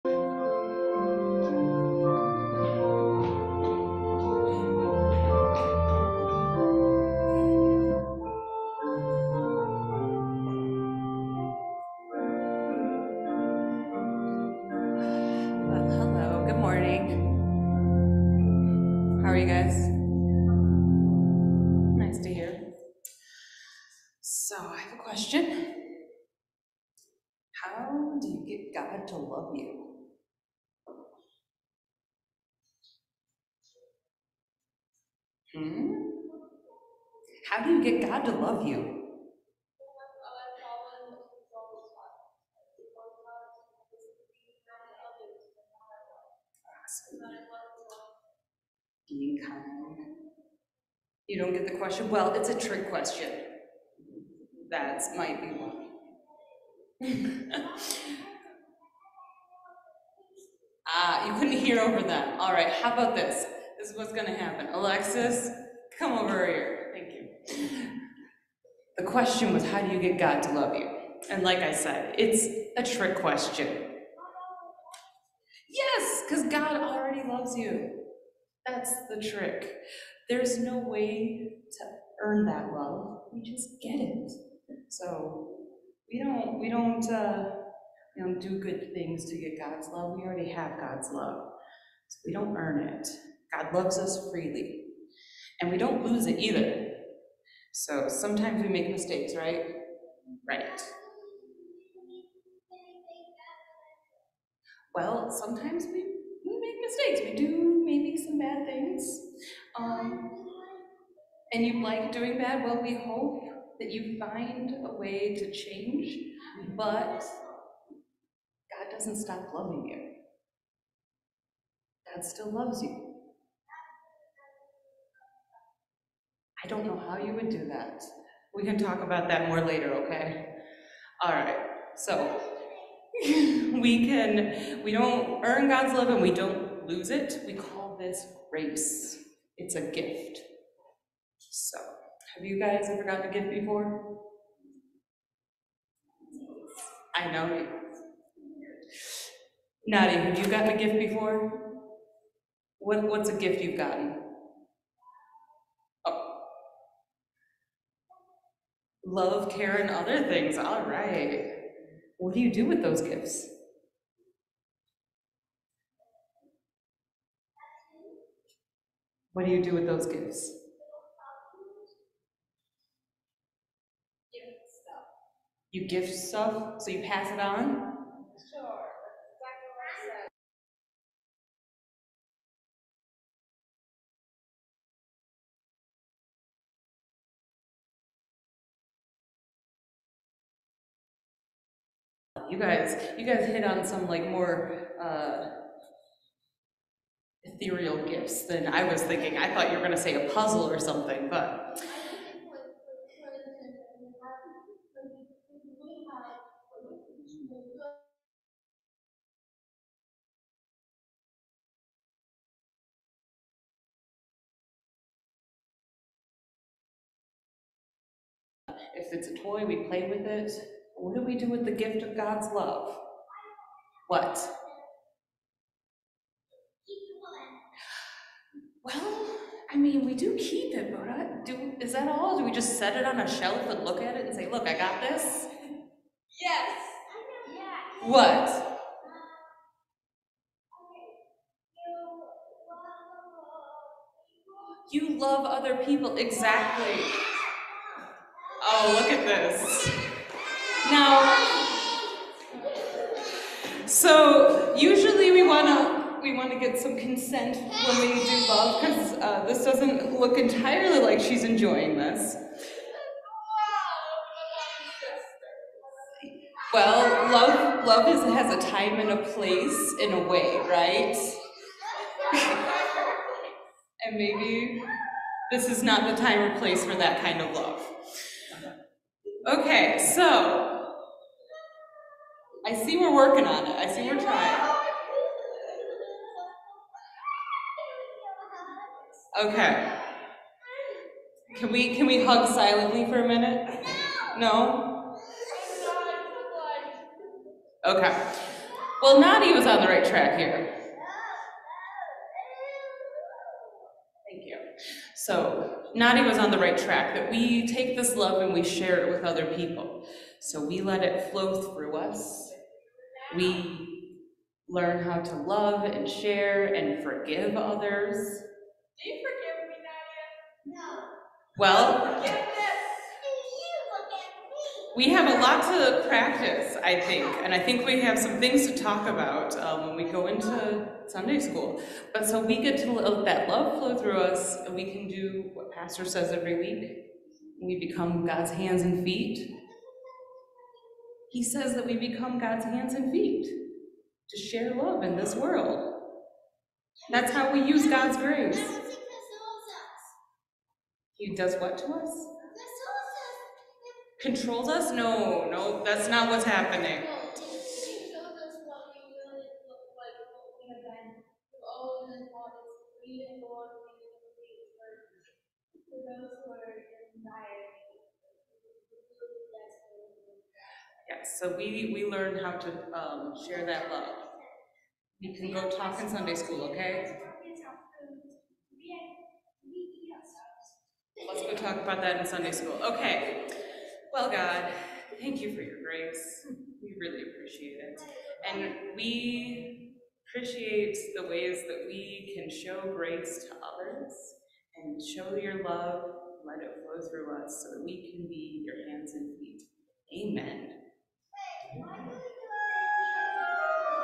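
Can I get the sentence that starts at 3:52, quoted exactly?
Do we just set it on a shelf and look at it and say, look, I got this?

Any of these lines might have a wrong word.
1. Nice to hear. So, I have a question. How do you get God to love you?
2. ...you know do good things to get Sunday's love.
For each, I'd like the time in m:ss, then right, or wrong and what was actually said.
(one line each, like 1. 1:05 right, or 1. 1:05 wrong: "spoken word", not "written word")
1. 0:21 right
2. 1:28 wrong: "God", not "Sunday".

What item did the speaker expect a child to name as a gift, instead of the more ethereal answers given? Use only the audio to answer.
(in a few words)
A puzzle.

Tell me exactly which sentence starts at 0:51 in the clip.
you don't get the question, well, it's a trick question.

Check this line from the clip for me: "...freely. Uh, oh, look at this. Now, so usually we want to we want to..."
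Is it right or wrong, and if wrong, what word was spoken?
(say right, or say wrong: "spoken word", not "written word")
wrong: "exactly", not "freely".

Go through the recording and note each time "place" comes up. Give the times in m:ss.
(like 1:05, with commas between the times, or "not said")
4:29, 4:36.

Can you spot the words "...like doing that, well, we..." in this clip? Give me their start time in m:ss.
1:51.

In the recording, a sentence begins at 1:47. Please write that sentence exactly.
We do maybe some bad things.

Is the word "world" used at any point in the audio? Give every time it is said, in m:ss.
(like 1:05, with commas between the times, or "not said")
5:45.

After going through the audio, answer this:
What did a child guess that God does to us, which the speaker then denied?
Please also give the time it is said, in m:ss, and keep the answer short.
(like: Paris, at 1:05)
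Controls us, at 5:54.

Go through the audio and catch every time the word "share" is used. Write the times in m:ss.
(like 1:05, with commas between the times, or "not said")
5:08, 5:16, 5:44, 6:13.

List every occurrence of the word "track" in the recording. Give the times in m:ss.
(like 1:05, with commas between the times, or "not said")
5:00, 5:06.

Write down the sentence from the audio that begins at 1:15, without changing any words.
Yes, because God already loves you.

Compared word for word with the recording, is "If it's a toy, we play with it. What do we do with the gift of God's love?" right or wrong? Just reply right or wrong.
right.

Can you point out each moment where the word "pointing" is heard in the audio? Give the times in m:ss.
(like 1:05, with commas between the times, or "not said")
not said.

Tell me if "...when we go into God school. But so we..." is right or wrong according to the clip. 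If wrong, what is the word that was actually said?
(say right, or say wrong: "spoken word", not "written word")
wrong: "Sunday", not "God".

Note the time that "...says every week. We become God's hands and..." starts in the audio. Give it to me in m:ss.
5:36.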